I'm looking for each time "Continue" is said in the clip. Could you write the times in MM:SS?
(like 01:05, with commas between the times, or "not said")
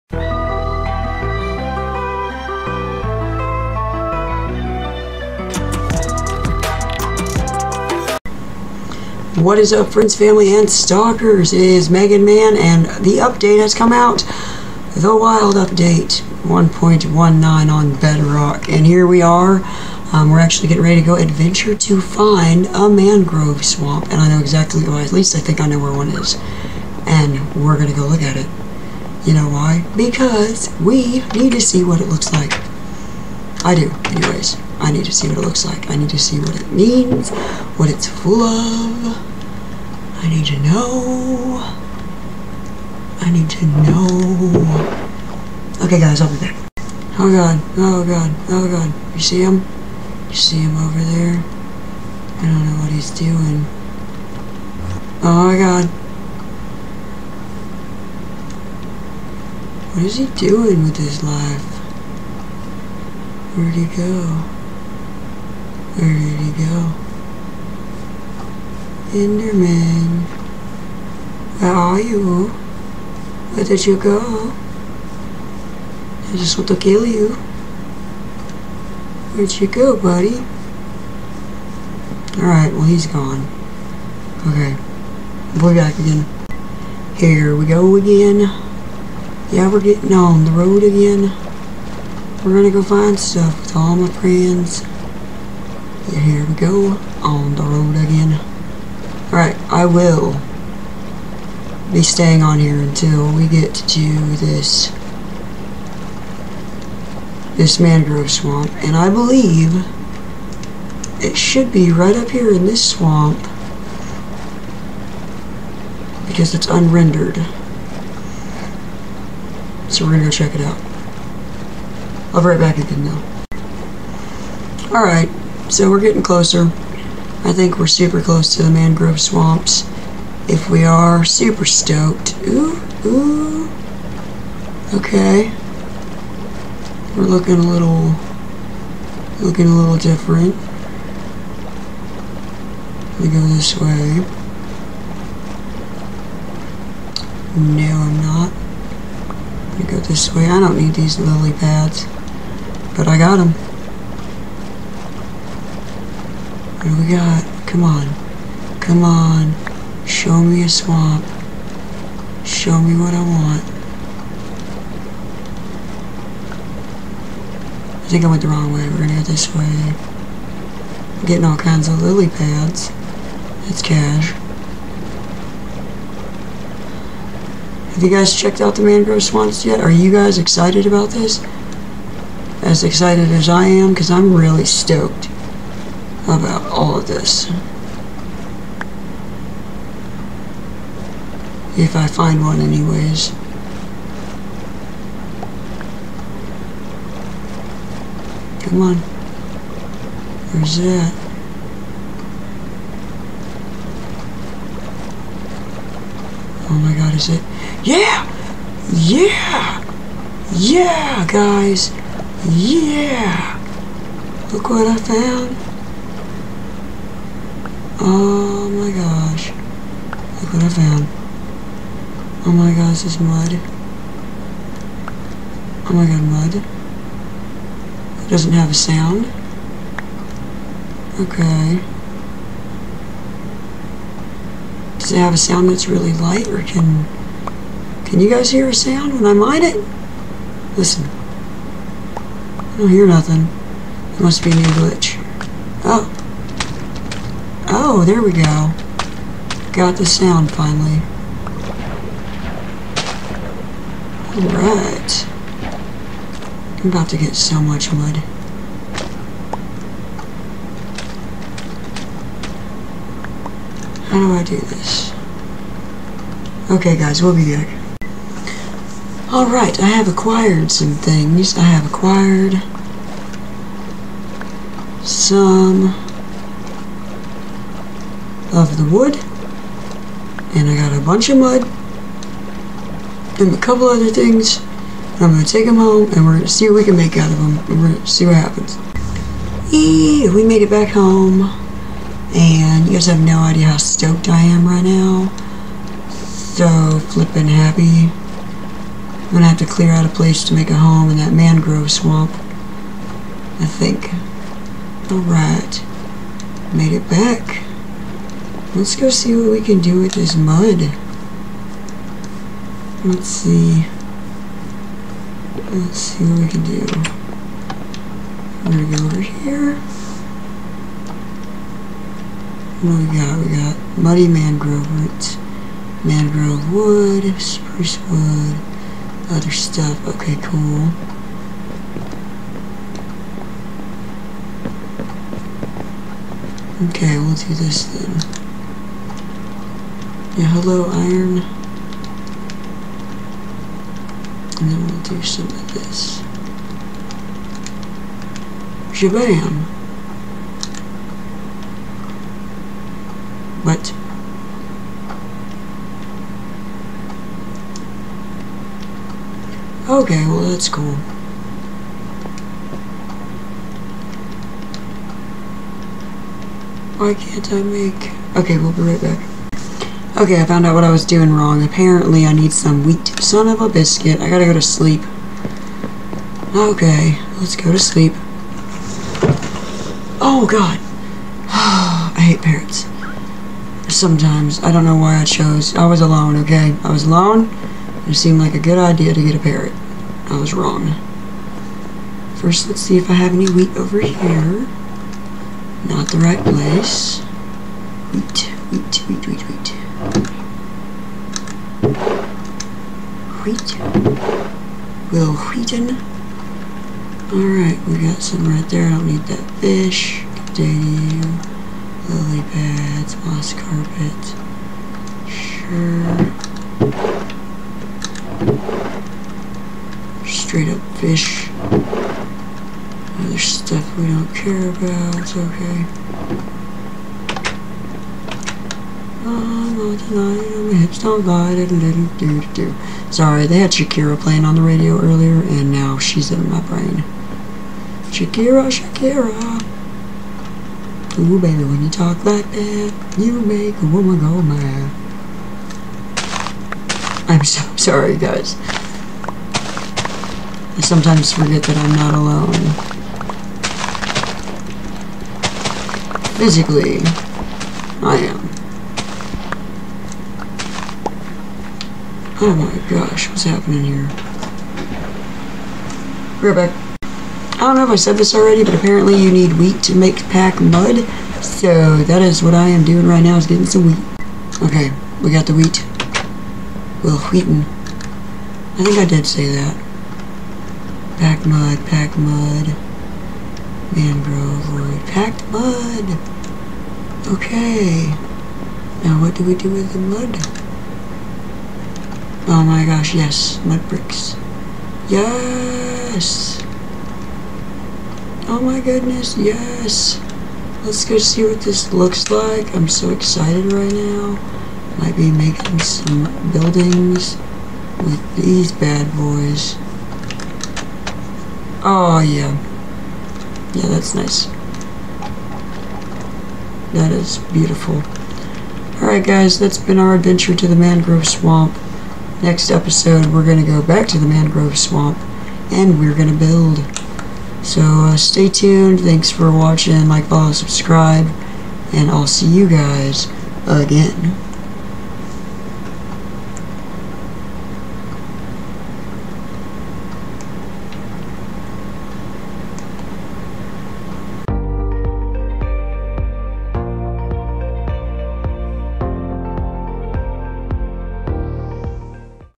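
06:50.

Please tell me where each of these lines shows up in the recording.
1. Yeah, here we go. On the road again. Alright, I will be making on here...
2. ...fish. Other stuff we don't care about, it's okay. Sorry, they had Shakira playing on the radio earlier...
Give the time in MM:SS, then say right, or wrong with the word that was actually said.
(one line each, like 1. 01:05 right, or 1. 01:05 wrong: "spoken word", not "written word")
1. 01:36 wrong: "staying", not "making"
2. 07:00 right.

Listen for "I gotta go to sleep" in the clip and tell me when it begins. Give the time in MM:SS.
06:14.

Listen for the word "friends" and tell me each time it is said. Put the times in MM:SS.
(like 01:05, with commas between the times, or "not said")
00:09, 01:34.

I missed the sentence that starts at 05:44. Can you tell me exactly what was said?
And then we'll do some of this.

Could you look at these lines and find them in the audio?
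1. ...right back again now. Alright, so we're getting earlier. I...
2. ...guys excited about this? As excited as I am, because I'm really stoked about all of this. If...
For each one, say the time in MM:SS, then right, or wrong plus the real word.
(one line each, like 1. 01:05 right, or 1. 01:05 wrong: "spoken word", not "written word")
1. 02:02 wrong: "closer", not "earlier"
2. 03:00 right.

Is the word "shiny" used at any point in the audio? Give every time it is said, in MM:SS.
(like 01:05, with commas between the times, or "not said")
not said.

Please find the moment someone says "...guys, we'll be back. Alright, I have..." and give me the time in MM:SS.
04:26.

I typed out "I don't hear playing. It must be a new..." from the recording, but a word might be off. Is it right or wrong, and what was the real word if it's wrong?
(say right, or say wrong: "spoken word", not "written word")
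wrong: "nothing", not "playing".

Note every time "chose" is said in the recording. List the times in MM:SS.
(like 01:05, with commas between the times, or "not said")
06:25.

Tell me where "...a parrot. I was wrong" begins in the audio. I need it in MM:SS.
06:29.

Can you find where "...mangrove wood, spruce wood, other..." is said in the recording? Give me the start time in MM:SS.
05:26.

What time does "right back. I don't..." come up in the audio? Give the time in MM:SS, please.
07:46.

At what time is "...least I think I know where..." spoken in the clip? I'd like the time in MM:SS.
00:25.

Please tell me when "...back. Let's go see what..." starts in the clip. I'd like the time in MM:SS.
05:07.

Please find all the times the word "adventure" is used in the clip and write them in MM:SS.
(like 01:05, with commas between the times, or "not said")
00:21, 08:40.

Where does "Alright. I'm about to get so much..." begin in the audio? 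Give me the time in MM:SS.
04:14.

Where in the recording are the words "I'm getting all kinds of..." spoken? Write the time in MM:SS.
02:51.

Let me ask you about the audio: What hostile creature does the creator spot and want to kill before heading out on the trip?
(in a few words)
Enderman.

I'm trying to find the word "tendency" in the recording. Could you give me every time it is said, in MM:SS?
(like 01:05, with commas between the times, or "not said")
not said.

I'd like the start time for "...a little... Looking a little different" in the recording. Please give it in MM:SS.
02:17.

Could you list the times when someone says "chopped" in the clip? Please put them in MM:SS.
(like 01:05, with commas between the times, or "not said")
not said.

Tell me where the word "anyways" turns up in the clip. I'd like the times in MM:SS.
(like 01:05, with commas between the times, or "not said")
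00:34, 03:12.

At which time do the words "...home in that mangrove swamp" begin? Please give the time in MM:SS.
05:00.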